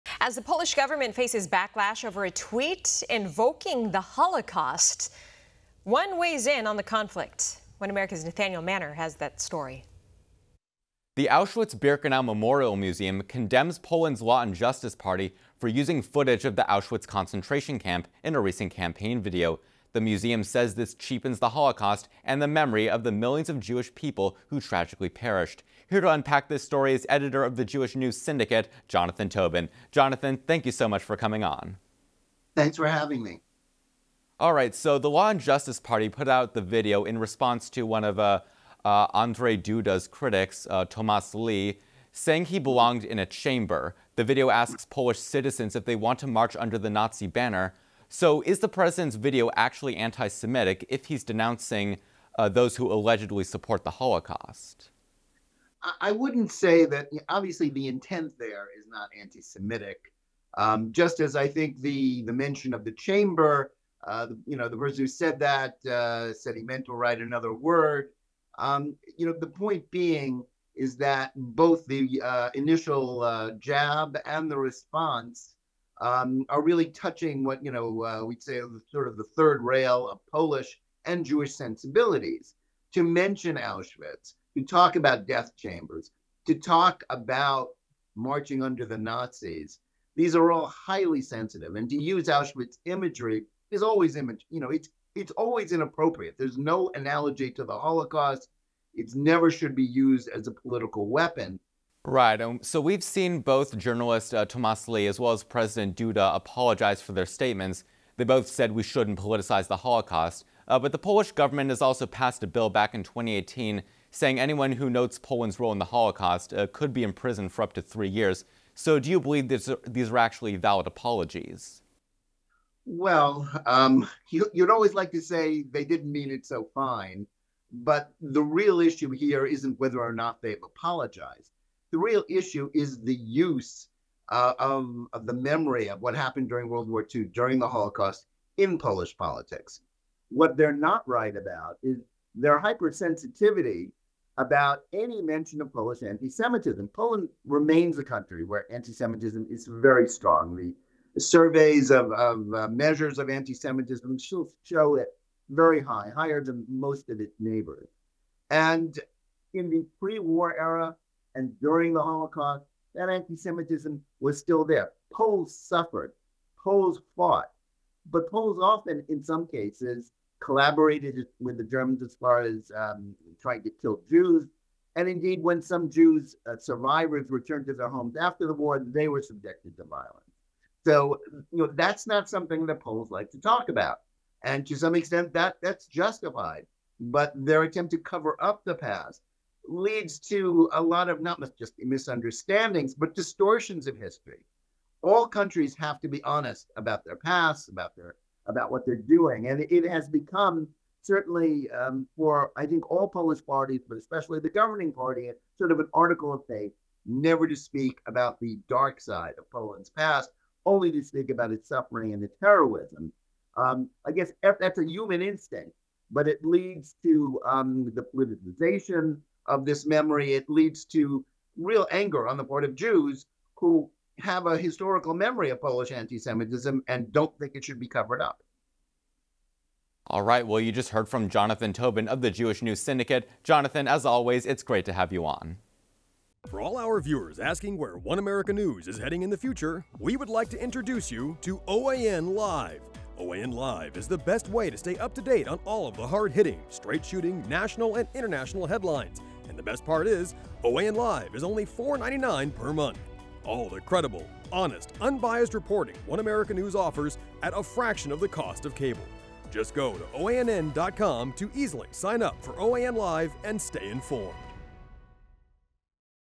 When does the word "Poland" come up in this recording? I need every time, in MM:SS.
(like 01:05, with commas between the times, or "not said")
00:13, 01:55, 02:26, 03:29.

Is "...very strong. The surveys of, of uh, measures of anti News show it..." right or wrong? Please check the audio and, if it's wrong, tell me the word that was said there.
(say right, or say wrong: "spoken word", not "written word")
wrong: "Semitism", not "News".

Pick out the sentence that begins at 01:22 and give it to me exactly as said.
To mention Auschwitz, to talk about death chambers, to talk about marching under the Nazis, these are all highly sensitive.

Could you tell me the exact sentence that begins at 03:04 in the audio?
And to some extent, that that's justified.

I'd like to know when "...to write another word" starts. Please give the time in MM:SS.
01:06.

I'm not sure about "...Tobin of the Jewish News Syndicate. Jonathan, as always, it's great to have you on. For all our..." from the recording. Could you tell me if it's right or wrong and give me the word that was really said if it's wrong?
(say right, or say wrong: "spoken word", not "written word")
right.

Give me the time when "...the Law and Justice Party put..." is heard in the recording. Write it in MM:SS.
00:34.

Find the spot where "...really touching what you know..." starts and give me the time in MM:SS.
01:16.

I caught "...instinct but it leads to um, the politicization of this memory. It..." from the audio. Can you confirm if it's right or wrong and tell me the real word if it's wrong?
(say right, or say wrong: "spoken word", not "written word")
right.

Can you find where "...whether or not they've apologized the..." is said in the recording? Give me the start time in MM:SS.
02:09.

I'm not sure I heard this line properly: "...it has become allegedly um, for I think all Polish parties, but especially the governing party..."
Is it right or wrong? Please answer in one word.
wrong.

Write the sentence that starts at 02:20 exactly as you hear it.
What they're not right about is their hypersensitivity about any mention of Polish anti Semitism.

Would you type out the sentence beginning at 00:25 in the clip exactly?
Here to unpack this story is editor of the Jewish News Syndicate, Jonathan Tobin.